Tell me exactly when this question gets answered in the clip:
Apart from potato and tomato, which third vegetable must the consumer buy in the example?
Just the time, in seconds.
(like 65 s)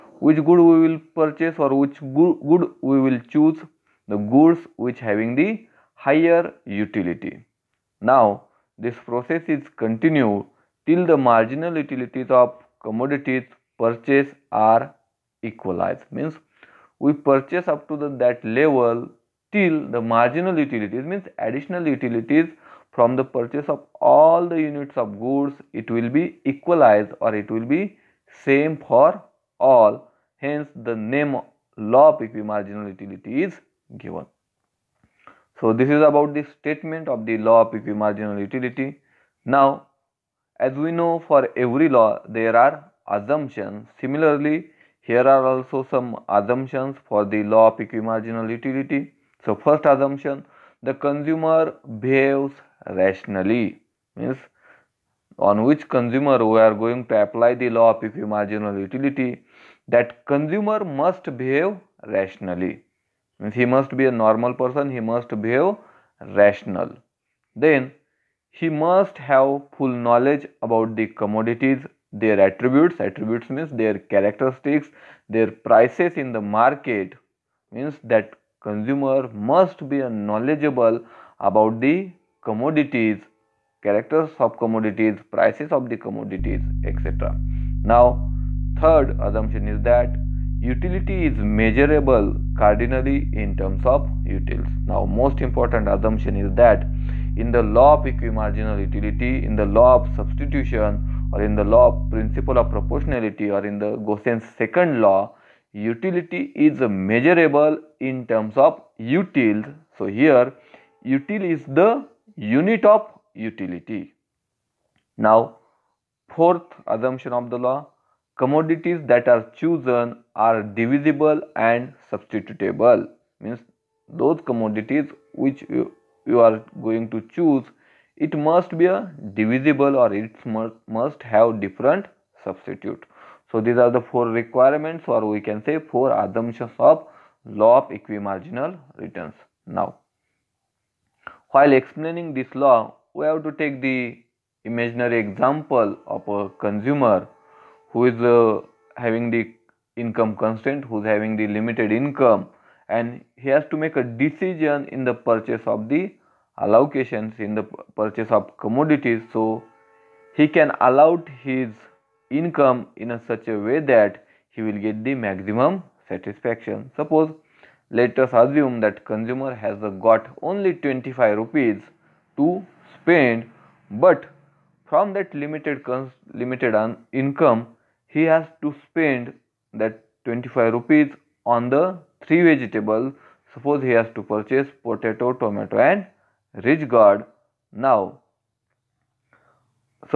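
186 s.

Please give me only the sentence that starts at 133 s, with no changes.
So these are the four requirements or we can say four assumptions of law of equimarginal returns.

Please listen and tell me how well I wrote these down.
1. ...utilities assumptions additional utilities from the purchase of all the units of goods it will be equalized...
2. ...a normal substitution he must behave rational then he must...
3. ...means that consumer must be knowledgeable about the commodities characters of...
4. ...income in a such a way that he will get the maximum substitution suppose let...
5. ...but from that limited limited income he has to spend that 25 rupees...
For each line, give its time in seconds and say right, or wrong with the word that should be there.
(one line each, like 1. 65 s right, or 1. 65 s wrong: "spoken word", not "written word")
1. 20 s wrong: "means", not "assumptions"
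2. 64 s wrong: "person", not "substitution"
3. 77 s right
4. 162 s wrong: "satisfaction", not "substitution"
5. 174 s right.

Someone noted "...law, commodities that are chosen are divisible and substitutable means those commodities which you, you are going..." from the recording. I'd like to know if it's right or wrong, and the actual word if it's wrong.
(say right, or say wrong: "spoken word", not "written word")
right.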